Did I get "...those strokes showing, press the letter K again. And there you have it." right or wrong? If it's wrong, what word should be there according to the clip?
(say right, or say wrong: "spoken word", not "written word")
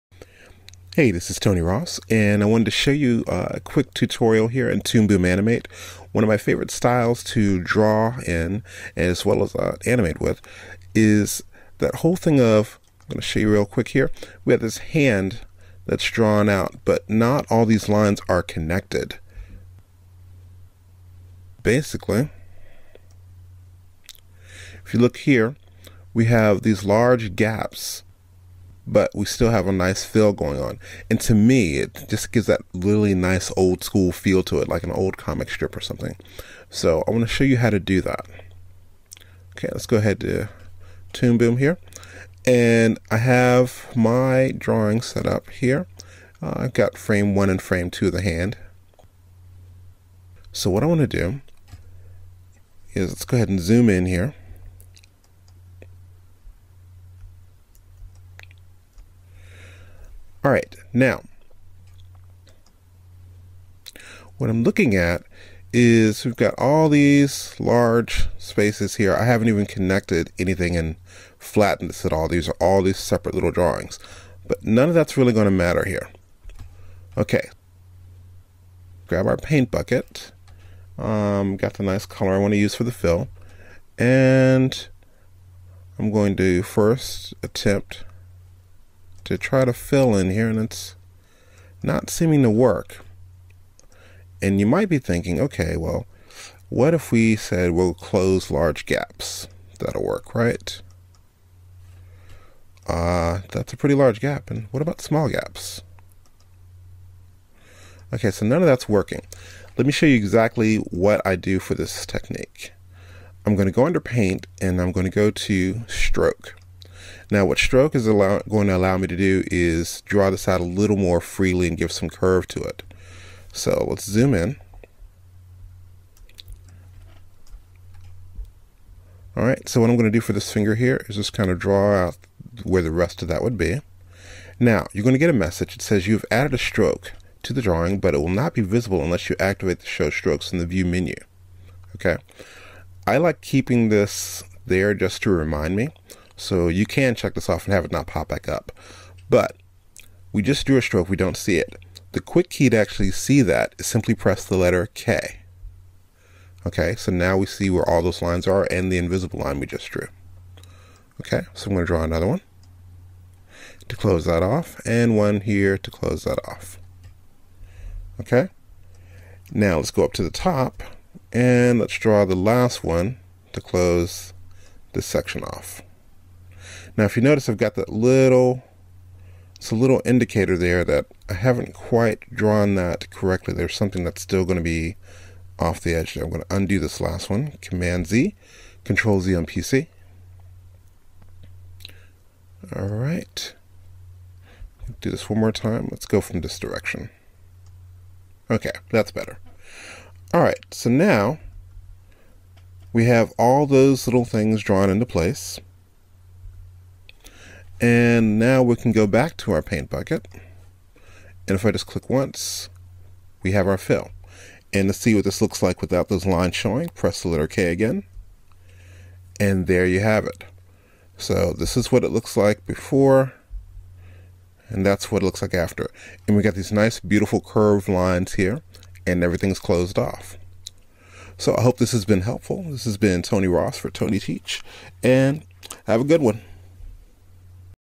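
wrong: "lines", not "strokes".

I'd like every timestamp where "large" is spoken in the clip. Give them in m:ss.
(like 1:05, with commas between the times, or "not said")
0:26, 1:07, 1:38, 1:43.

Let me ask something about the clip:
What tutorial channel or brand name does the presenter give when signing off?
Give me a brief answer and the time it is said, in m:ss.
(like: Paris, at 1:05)
Tony Teach, at 3:53.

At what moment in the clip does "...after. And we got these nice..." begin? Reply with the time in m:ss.
3:45.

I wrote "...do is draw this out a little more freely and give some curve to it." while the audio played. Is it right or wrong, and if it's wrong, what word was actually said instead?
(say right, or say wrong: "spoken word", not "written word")
right.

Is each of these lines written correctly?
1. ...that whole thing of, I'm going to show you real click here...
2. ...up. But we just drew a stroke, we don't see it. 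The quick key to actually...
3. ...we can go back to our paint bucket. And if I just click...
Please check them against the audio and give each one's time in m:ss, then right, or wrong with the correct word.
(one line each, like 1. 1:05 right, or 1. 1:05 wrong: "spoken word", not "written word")
1. 0:11 wrong: "quick", not "click"
2. 2:28 right
3. 3:28 right.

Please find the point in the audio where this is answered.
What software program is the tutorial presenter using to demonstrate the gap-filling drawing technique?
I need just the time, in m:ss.
0:04.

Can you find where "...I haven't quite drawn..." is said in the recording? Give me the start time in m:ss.
3:01.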